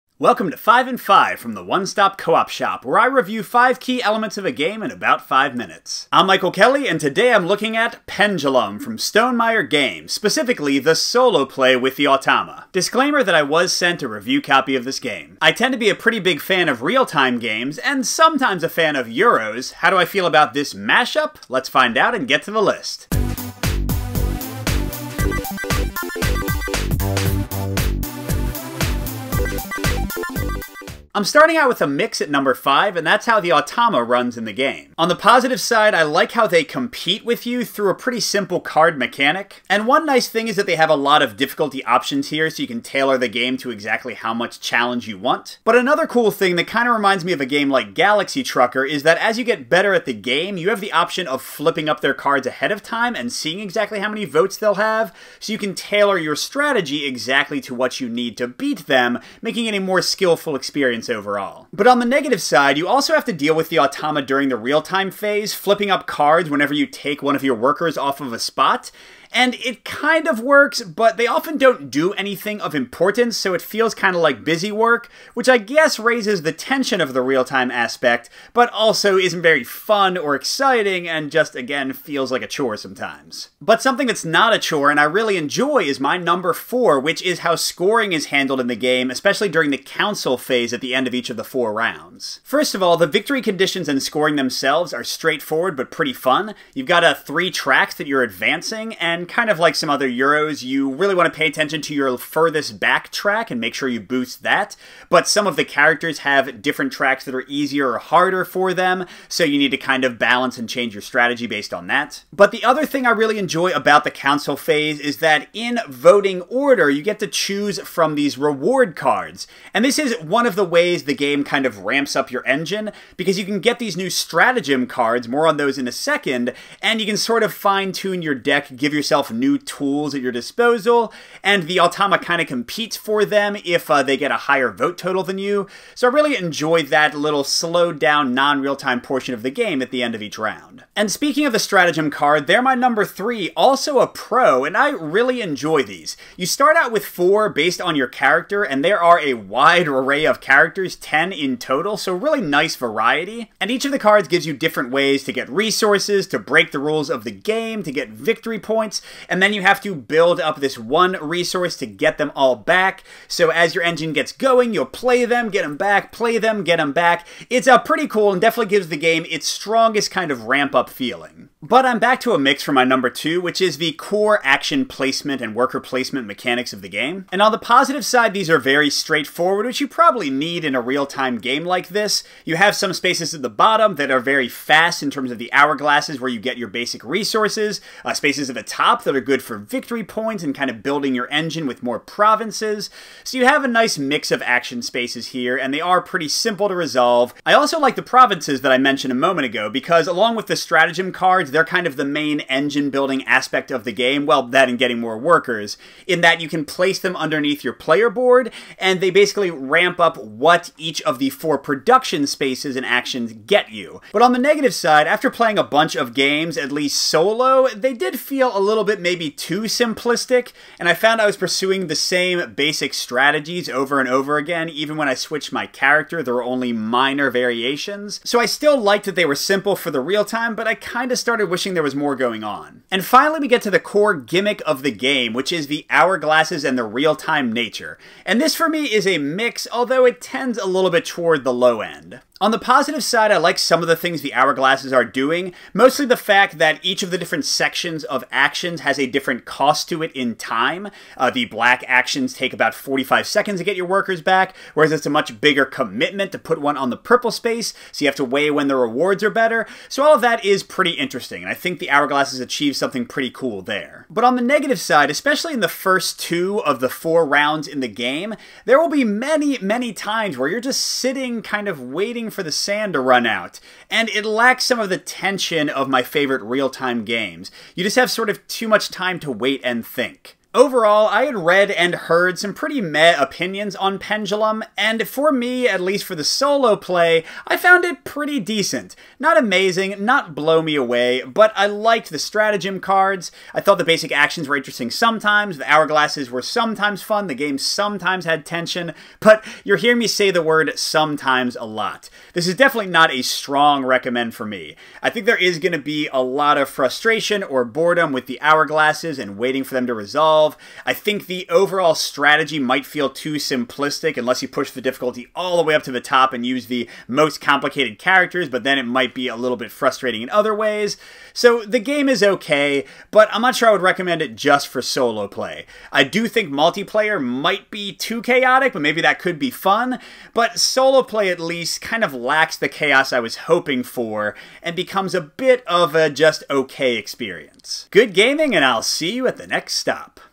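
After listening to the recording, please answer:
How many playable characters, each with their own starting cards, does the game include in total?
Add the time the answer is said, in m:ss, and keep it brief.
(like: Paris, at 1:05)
10, at 2:30.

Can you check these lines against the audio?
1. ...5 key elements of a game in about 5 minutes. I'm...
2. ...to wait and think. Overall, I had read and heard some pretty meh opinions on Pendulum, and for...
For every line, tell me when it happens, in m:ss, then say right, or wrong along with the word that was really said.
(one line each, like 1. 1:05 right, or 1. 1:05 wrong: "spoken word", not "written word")
1. 0:03 right
2. 4:39 right.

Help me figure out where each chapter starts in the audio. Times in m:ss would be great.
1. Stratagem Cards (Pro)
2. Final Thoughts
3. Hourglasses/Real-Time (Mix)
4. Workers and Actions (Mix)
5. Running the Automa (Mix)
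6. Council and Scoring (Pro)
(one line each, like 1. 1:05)
1. 2:20
2. 4:40
3. 3:52
4. 2:51
5. 0:31
6. 1:23.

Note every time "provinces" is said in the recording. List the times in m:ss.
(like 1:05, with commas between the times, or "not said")
3:11, 3:18.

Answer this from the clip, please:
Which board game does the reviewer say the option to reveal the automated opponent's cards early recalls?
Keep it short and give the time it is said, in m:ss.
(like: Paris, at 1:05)
Galaxy Trucker, at 0:47.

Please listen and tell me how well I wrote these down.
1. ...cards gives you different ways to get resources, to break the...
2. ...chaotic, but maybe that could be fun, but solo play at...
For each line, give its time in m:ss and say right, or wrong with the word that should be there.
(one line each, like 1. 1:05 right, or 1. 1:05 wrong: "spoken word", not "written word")
1. 2:33 right
2. 5:28 right.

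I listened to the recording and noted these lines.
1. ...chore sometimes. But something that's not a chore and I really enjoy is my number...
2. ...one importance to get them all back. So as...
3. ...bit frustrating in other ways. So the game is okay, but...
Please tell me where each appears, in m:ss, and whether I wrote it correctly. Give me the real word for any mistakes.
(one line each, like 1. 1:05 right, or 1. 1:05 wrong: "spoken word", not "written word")
1. 1:22 right
2. 2:40 wrong: "resource", not "importance"
3. 5:19 right.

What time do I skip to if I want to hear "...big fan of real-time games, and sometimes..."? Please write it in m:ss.
0:16.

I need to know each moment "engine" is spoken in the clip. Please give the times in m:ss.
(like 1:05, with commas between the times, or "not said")
2:02, 2:43, 3:11, 3:22.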